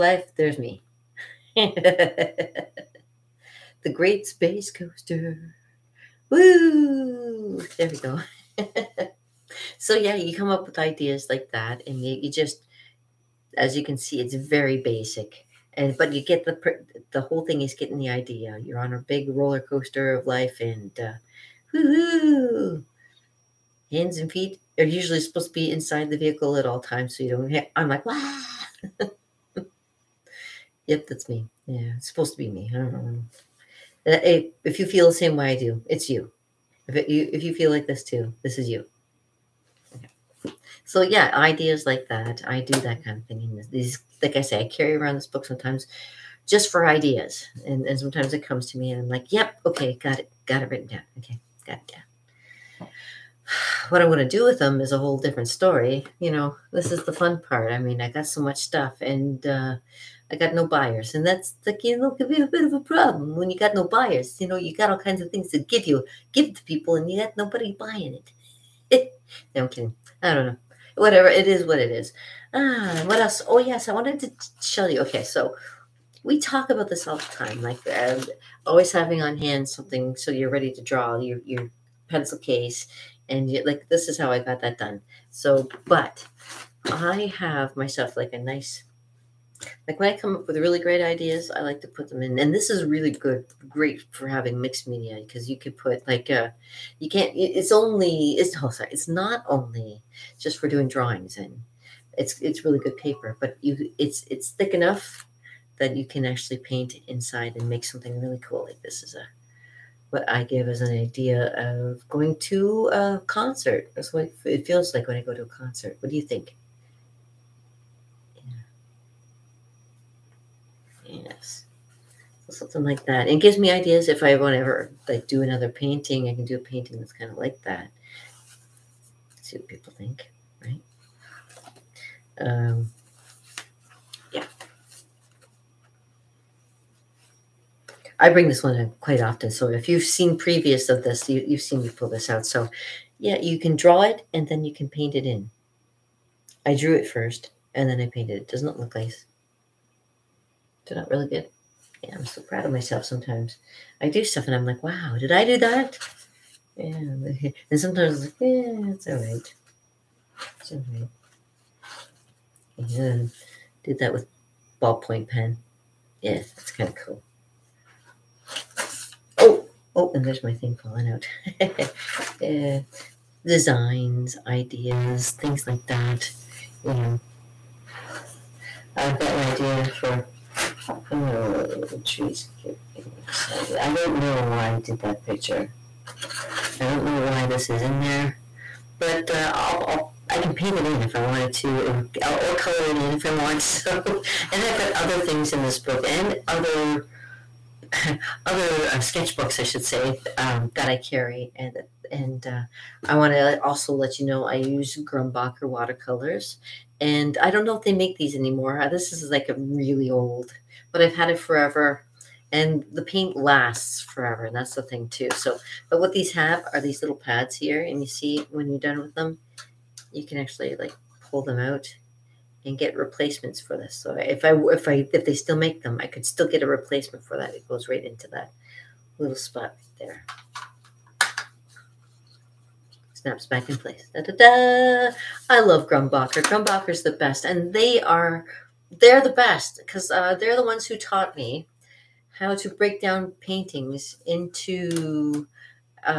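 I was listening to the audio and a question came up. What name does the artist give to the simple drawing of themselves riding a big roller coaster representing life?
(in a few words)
the Great Space Coaster.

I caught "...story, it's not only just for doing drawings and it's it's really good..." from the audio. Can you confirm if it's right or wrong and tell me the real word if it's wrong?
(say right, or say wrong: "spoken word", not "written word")
wrong: "sorry", not "story".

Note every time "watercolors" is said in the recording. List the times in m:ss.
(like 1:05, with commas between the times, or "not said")
3:25.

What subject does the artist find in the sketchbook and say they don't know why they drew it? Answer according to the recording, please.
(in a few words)
trees.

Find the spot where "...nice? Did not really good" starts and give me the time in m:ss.
2:28.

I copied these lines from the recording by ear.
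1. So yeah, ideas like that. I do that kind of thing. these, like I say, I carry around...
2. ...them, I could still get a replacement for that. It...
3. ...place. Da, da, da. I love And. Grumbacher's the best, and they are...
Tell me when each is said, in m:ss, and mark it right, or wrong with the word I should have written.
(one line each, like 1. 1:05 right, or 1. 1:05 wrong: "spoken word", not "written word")
1. 0:40 right
2. 3:45 right
3. 3:53 wrong: "Grumbacher", not "And".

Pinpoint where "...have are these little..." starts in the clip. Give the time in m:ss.
3:36.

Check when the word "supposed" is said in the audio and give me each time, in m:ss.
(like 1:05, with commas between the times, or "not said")
0:25, 0:32.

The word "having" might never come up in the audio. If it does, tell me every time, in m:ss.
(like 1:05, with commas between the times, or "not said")
1:18, 1:34.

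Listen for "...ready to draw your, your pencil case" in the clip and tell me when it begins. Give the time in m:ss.
1:20.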